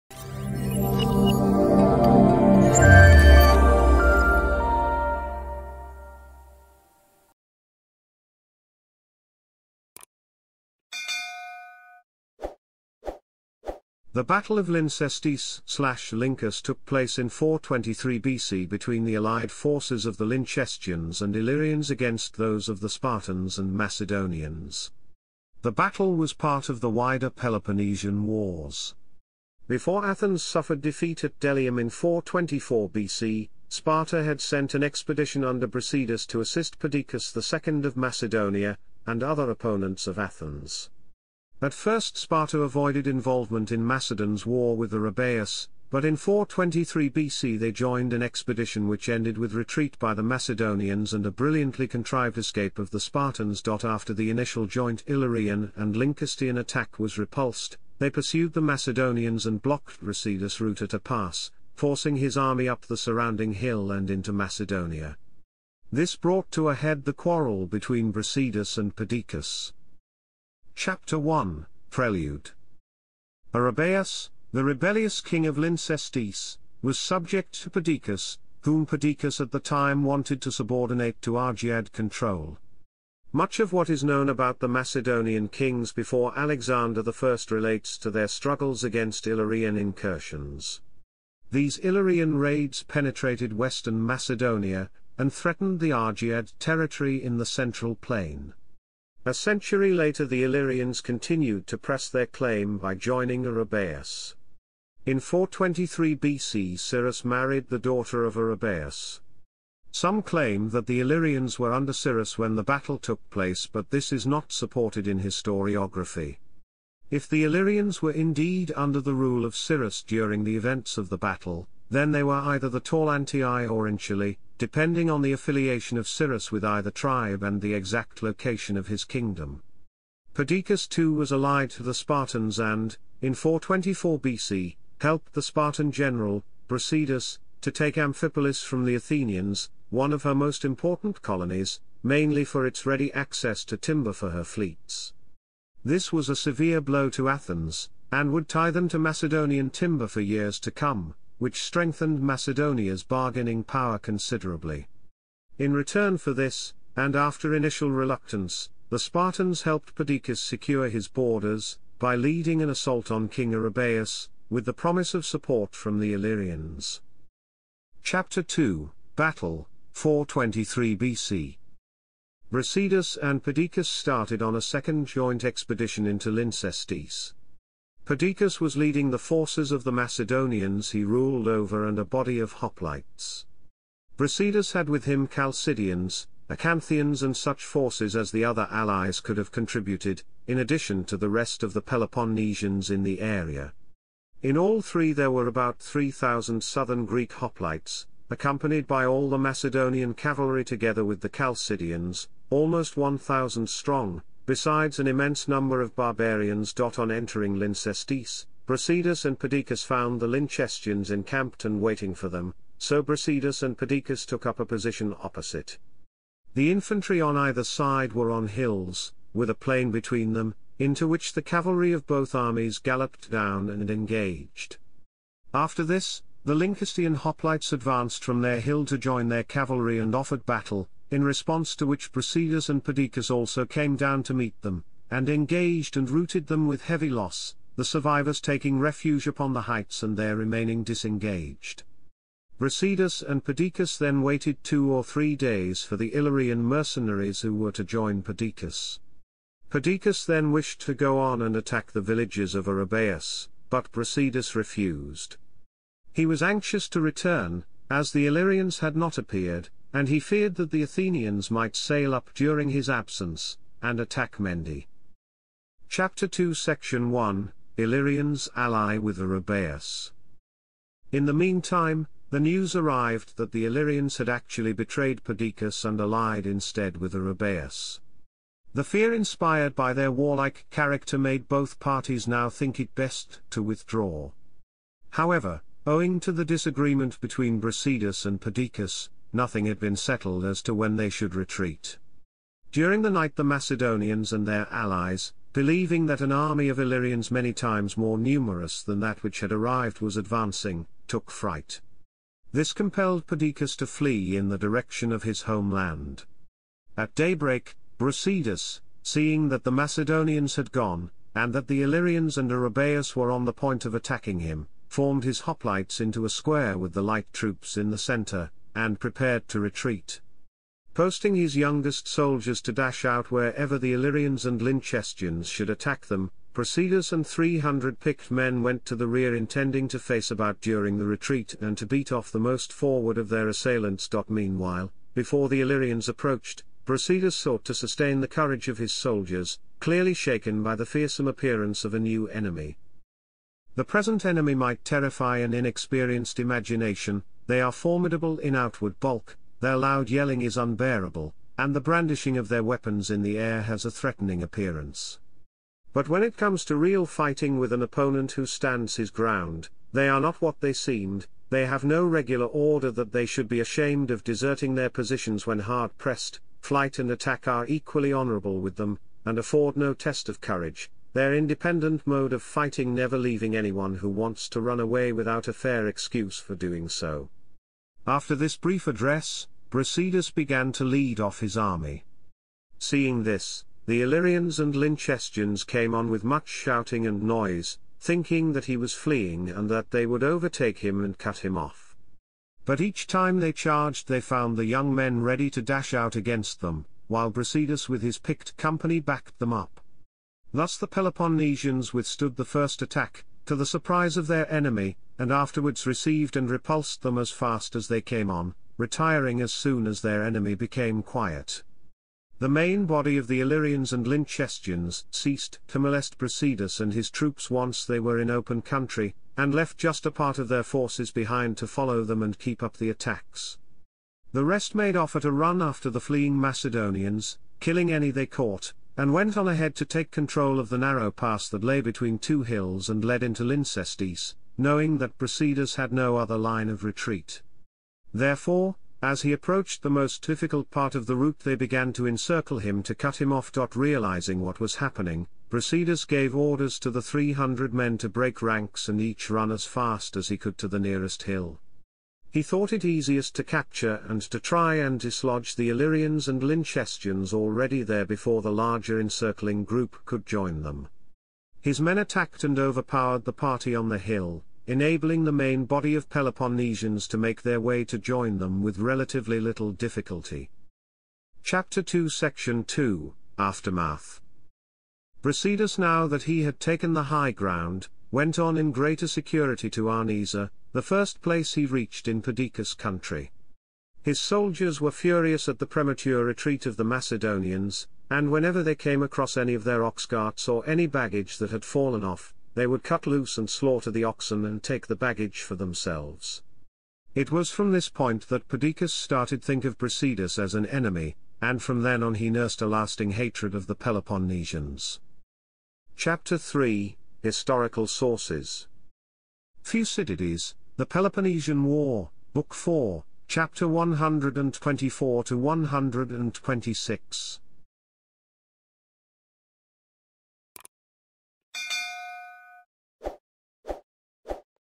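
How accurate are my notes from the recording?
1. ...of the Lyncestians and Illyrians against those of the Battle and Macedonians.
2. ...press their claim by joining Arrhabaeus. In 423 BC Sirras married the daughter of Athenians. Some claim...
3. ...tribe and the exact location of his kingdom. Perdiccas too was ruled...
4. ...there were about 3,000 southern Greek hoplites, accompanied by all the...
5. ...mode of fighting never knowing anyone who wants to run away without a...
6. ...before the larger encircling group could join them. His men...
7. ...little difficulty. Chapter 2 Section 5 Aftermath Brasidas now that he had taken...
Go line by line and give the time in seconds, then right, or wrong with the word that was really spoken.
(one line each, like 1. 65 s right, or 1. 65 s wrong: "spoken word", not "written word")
1. 20 s wrong: "Spartans", not "Battle"
2. 101 s wrong: "Arrhabaeus", not "Athenians"
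3. 126 s wrong: "allied", not "ruled"
4. 195 s right
5. 372 s wrong: "leaving", not "knowing"
6. 458 s right
7. 469 s wrong: "2", not "5".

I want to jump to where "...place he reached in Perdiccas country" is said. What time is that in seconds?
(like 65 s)
481 s.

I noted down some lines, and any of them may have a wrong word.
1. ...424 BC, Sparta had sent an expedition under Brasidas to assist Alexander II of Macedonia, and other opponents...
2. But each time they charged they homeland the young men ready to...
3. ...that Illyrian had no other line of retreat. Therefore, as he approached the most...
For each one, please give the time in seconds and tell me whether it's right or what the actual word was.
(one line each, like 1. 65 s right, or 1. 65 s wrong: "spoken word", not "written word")
1. 31 s wrong: "Perdiccas", not "Alexander"
2. 392 s wrong: "found", not "homeland"
3. 434 s wrong: "Brasidas", not "Illyrian".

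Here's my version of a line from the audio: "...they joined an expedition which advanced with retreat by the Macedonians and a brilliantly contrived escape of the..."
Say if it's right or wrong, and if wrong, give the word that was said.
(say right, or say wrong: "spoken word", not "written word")
wrong: "ended", not "advanced".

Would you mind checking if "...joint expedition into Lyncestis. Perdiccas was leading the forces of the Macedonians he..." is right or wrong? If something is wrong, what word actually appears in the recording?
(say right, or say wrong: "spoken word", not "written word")
right.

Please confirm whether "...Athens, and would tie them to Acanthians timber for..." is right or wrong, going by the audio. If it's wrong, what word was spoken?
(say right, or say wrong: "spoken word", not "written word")
wrong: "Macedonian", not "Acanthians".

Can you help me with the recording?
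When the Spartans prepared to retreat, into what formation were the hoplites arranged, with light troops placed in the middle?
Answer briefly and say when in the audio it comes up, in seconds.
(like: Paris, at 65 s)
A square, at 316 s.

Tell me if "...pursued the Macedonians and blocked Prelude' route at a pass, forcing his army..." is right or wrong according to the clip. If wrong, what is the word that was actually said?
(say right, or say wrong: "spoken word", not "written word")
wrong: "Brasidas", not "Prelude".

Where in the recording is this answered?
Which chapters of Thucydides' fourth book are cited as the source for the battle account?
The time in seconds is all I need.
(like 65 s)
513 s.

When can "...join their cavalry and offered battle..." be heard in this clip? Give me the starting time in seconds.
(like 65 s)
228 s.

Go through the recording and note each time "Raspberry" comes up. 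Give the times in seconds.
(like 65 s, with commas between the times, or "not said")
not said.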